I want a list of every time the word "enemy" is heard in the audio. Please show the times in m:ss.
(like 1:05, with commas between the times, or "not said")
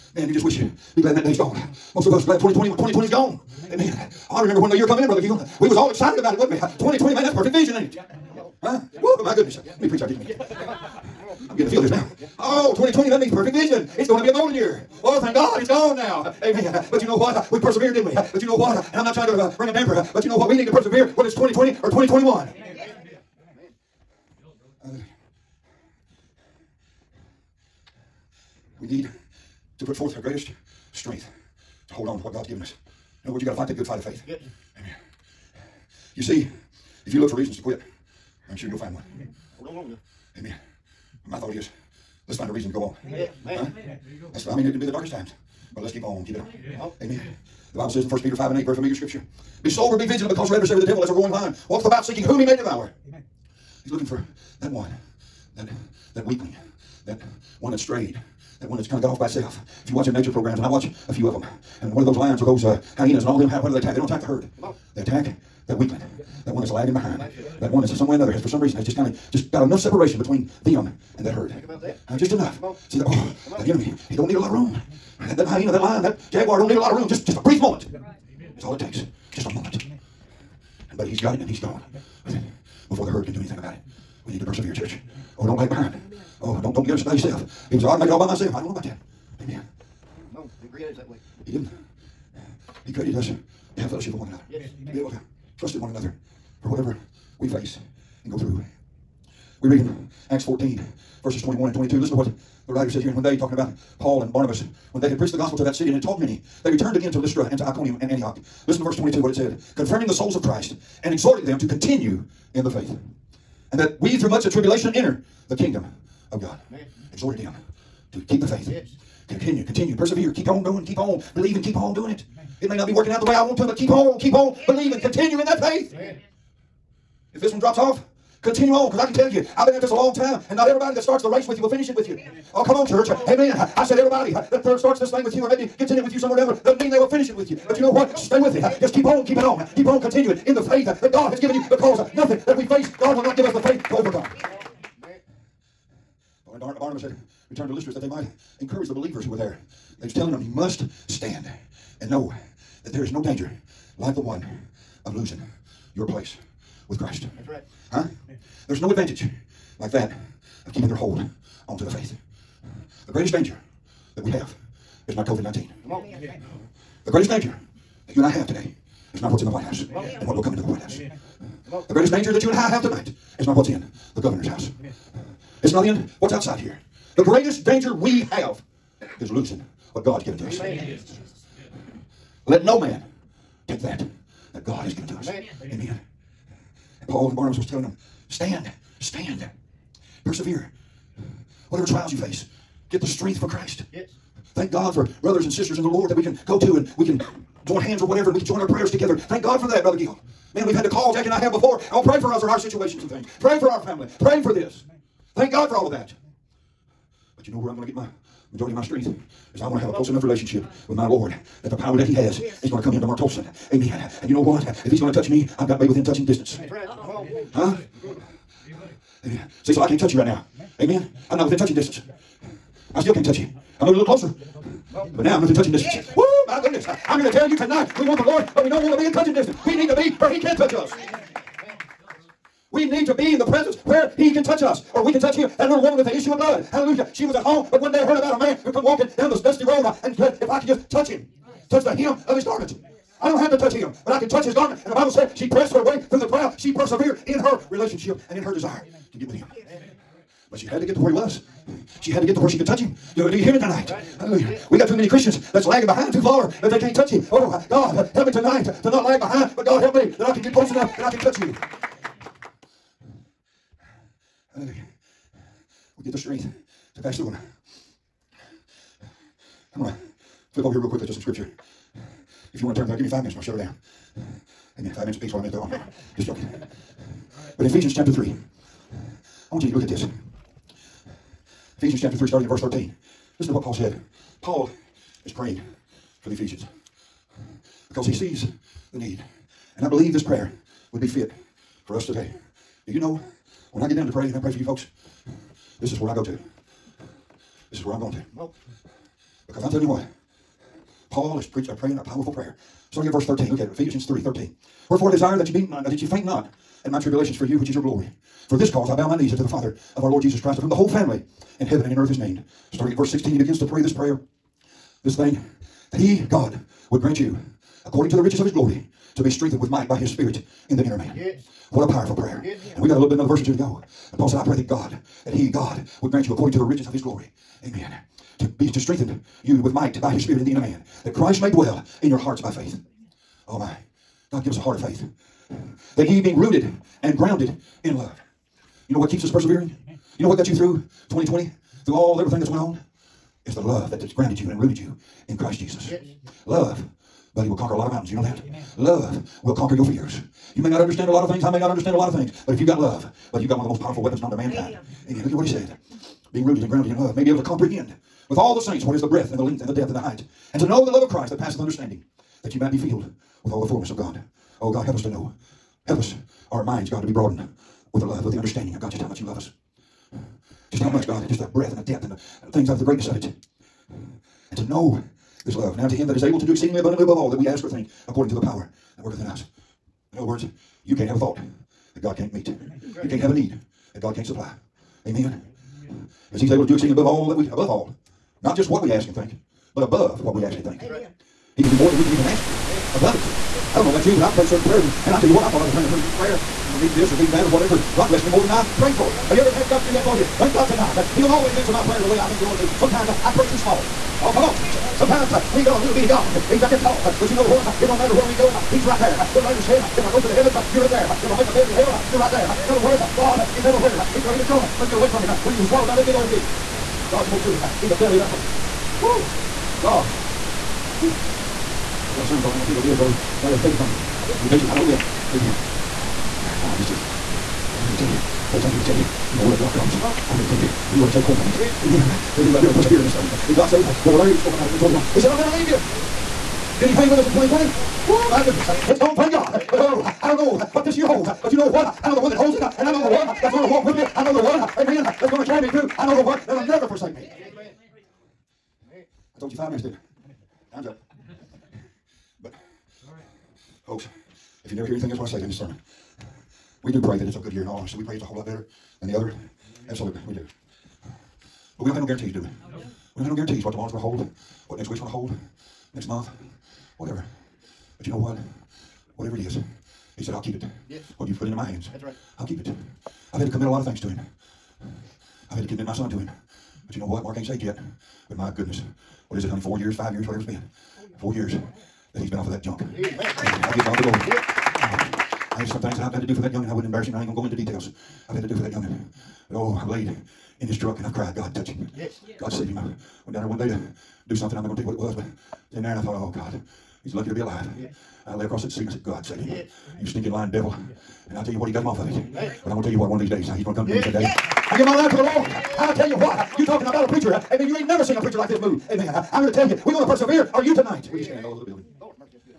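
1:13.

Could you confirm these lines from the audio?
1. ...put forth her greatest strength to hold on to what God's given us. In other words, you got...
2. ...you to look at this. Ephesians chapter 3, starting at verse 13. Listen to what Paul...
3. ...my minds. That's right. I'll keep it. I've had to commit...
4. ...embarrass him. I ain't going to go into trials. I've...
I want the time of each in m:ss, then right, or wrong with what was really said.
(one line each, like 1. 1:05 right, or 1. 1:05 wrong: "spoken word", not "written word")
1. 0:29 right
2. 4:39 right
3. 7:51 wrong: "hands", not "minds"
4. 8:06 wrong: "details", not "trials".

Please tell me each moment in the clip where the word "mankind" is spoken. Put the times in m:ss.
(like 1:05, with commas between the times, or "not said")
5:54.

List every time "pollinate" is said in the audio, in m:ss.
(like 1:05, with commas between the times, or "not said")
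not said.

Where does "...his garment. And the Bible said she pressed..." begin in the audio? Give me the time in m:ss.
4:04.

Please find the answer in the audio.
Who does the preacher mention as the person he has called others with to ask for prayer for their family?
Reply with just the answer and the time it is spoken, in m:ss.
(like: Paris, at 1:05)
Jackie, at 3:21.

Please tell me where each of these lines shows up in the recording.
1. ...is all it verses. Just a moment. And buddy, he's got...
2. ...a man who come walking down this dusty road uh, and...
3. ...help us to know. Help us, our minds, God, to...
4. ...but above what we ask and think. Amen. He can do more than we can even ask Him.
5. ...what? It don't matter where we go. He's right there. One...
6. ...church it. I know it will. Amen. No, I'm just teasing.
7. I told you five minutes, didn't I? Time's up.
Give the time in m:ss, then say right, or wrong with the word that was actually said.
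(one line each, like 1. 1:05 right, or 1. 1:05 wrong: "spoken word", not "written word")
1. 1:18 wrong: "takes", not "verses"
2. 3:58 right
3. 6:04 right
4. 6:29 right
5. 6:47 right
6. 7:04 wrong: "preach", not "church"
7. 7:29 right.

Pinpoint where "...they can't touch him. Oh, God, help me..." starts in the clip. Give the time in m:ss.
4:16.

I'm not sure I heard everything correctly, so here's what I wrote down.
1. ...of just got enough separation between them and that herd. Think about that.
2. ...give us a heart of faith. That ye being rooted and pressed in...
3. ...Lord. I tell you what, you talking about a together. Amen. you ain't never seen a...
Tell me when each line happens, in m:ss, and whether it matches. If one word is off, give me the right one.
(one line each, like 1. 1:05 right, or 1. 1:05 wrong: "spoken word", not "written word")
1. 1:09 right
2. 5:34 wrong: "grounded", not "pressed"
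3. 8:25 wrong: "preacher", not "together".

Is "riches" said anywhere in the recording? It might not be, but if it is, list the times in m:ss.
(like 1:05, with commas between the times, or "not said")
5:18, 5:26.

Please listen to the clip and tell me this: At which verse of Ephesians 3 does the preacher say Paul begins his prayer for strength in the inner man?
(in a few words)
Verse 16.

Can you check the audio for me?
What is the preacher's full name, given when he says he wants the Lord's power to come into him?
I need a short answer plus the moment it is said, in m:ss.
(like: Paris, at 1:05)
Mark Tolson, at 3:33.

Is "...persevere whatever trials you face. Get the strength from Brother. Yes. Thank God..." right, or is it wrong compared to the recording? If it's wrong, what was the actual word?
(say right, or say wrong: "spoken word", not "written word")
wrong: "Christ", not "Brother".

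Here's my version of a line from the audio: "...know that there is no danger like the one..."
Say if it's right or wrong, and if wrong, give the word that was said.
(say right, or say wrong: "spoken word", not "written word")
right.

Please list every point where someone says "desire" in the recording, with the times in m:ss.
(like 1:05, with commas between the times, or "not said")
4:08, 5:05.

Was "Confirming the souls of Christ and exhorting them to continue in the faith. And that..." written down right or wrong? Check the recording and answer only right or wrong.
right.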